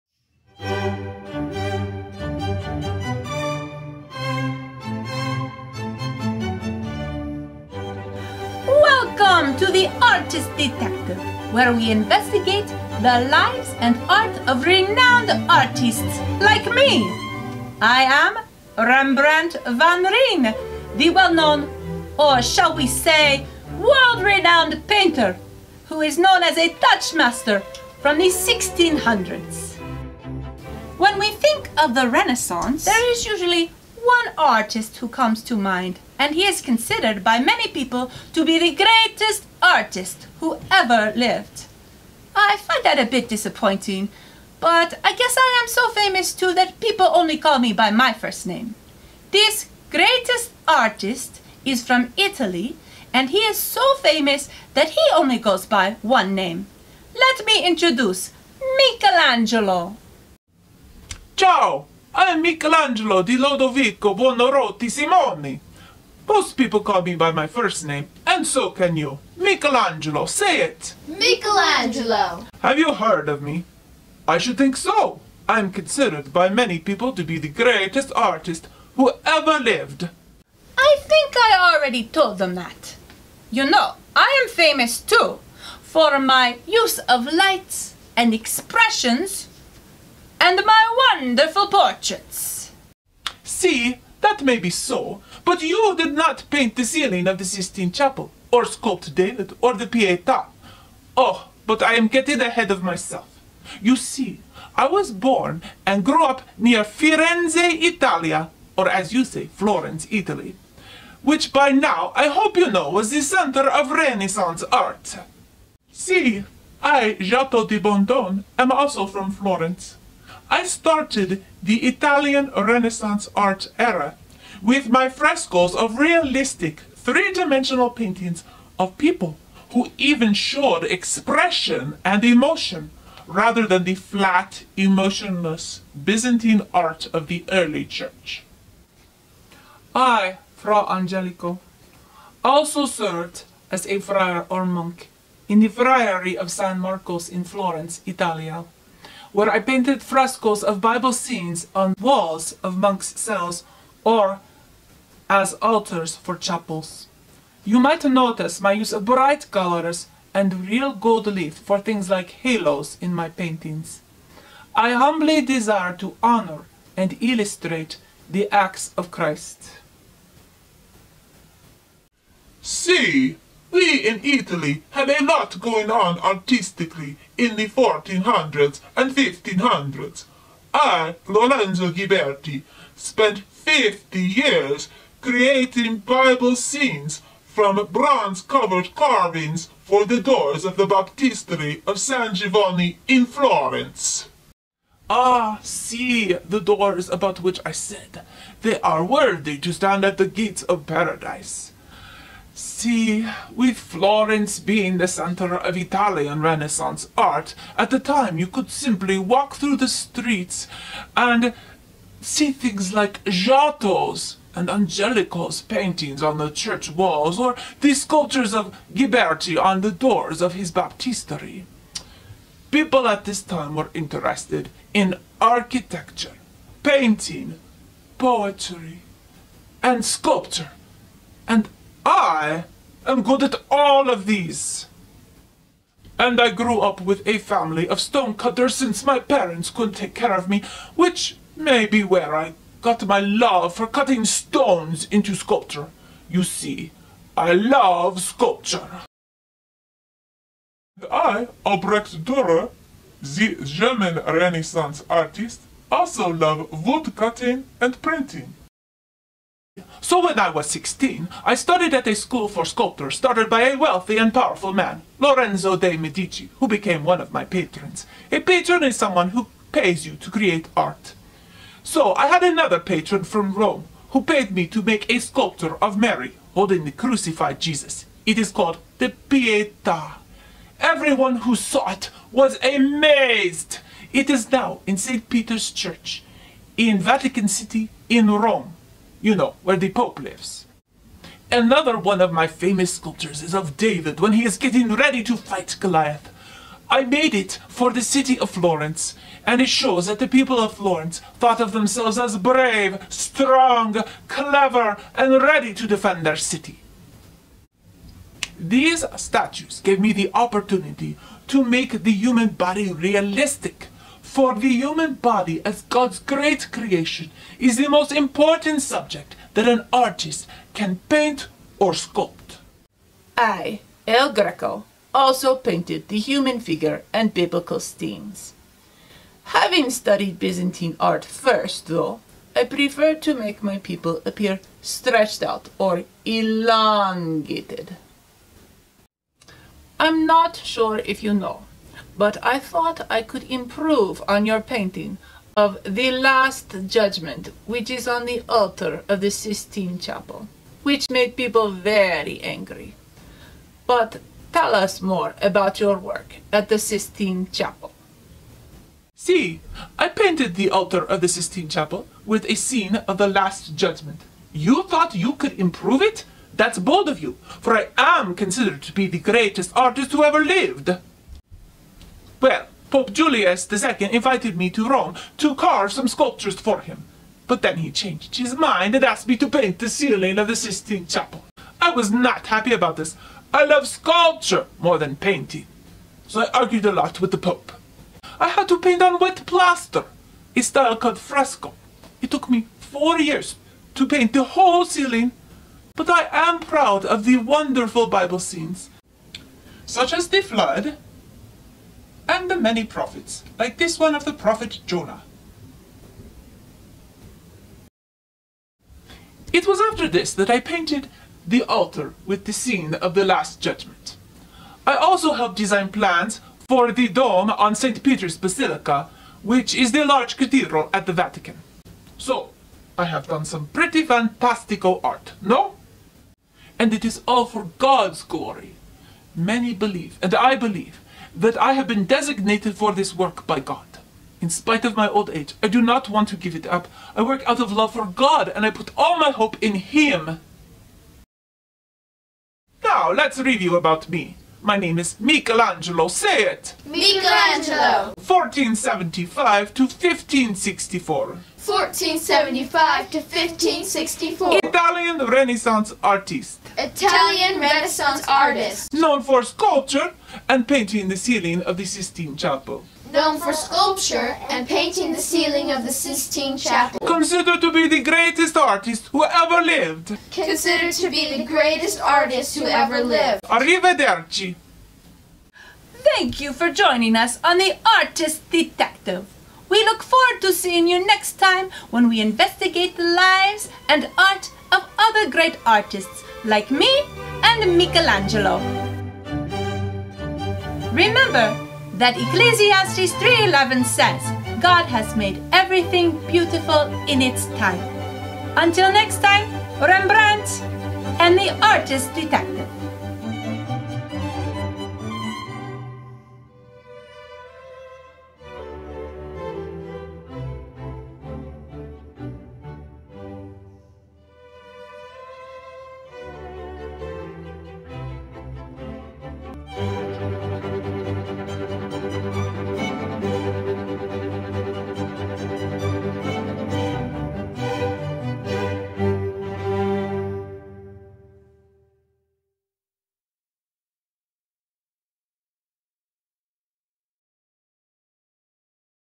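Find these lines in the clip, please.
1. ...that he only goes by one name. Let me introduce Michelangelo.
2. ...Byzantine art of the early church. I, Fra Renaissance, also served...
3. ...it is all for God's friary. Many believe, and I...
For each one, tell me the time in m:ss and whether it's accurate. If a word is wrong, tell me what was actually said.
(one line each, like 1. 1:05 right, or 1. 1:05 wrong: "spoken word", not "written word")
1. 0:54 right
2. 2:15 wrong: "Angelico", not "Renaissance"
3. 7:06 wrong: "glory", not "friary".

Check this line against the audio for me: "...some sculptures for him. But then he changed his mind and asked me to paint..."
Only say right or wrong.
right.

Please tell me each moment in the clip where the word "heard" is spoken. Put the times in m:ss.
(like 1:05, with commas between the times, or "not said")
1:12.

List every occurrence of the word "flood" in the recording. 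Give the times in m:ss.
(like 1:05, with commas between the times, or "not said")
6:40.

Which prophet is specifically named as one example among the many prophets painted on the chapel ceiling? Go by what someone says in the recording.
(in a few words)
Jonah.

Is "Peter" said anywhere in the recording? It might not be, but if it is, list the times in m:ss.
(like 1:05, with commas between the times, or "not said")
4:45, 6:58.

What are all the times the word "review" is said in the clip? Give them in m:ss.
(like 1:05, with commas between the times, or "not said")
7:23.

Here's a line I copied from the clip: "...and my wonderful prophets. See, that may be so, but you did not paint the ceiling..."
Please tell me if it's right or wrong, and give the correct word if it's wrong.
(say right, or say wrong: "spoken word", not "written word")
wrong: "portraits", not "prophets".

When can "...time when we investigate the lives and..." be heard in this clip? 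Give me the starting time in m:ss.
8:01.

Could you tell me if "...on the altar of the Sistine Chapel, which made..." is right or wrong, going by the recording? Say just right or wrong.
right.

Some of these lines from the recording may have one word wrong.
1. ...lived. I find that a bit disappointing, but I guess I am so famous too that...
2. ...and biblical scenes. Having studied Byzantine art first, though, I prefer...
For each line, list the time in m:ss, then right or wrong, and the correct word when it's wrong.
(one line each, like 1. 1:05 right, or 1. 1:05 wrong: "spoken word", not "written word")
1. 0:41 right
2. 5:27 right.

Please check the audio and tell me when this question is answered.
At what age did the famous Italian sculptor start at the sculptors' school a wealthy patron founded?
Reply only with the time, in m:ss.
4:20.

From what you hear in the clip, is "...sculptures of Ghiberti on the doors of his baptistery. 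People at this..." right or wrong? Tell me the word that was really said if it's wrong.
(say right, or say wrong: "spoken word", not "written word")
right.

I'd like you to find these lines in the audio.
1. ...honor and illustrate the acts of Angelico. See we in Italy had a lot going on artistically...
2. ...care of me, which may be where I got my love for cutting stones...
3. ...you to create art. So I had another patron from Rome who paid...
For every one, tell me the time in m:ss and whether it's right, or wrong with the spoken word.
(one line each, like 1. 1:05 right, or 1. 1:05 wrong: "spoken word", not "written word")
1. 2:46 wrong: "Christ", not "Angelico"
2. 4:00 right
3. 4:30 right.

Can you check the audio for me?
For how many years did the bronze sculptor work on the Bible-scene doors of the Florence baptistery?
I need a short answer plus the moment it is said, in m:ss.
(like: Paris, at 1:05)
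50, at 3:03.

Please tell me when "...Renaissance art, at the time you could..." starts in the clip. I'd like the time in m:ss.
3:26.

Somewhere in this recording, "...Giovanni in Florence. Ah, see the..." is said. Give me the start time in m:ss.
3:12.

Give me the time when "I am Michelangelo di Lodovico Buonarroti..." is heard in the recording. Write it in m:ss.
1:02.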